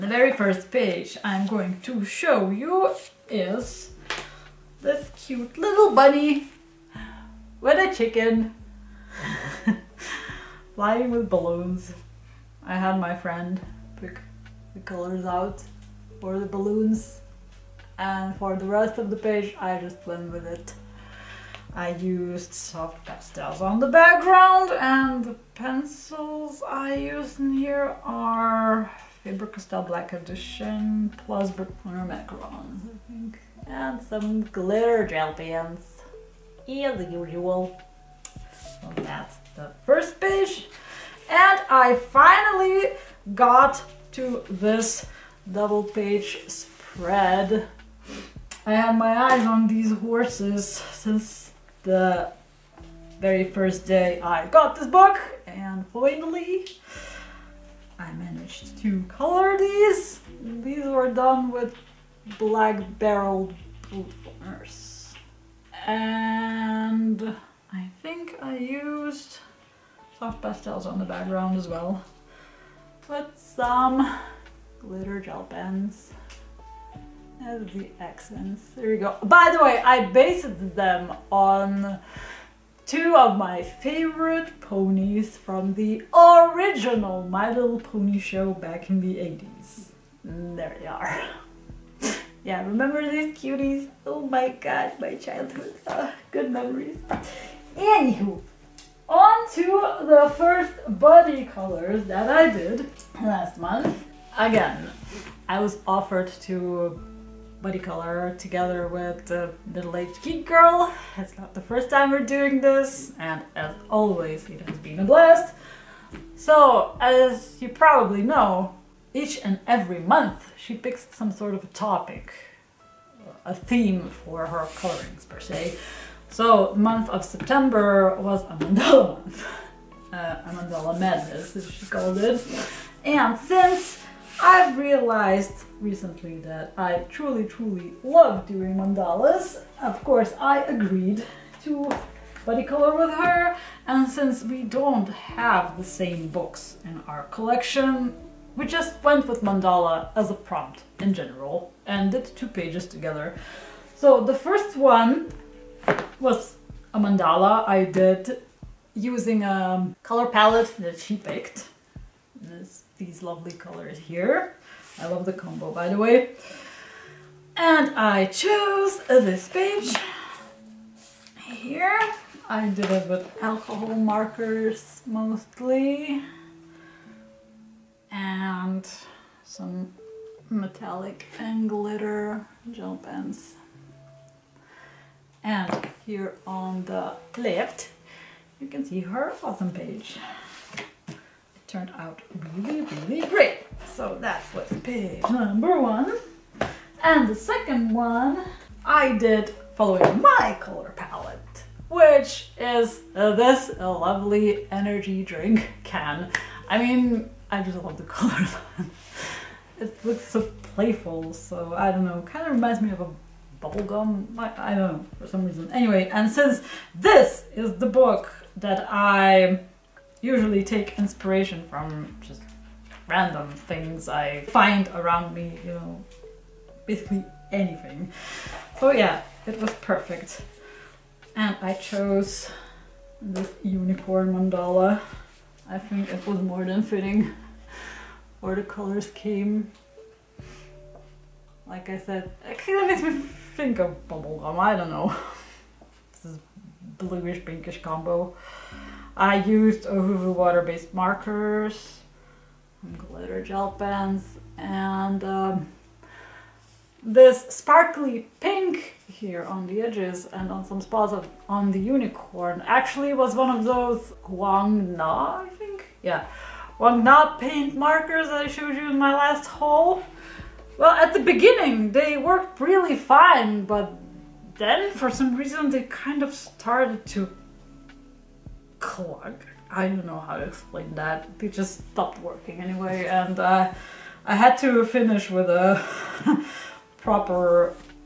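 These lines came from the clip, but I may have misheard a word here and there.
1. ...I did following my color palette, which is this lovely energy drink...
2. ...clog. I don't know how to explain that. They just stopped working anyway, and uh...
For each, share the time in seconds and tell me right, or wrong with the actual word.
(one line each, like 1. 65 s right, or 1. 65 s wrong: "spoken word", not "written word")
1. 198 s right
2. 278 s right.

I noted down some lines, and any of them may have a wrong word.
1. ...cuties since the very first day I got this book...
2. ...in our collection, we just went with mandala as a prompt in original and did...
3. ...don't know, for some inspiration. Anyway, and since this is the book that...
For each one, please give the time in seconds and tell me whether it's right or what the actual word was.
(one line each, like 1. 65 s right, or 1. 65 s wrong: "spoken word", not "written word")
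1. 49 s wrong: "horses", not "cuties"
2. 146 s wrong: "general", not "original"
3. 214 s wrong: "reason", not "inspiration".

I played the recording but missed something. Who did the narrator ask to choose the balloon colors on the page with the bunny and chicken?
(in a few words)
My friend.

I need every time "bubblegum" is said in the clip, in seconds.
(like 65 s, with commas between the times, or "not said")
213 s, 244 s.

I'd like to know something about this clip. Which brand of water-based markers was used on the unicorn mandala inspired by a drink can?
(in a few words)
Ohuhu.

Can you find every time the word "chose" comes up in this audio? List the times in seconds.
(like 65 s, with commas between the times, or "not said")
168 s, 231 s.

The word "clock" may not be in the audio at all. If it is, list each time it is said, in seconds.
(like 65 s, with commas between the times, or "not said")
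not said.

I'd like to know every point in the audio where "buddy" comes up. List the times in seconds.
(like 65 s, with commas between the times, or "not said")
100 s, 107 s, 142 s.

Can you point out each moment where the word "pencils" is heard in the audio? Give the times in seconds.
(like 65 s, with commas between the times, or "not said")
25 s.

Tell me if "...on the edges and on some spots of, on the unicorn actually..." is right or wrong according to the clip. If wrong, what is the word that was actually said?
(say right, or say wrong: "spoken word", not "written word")
right.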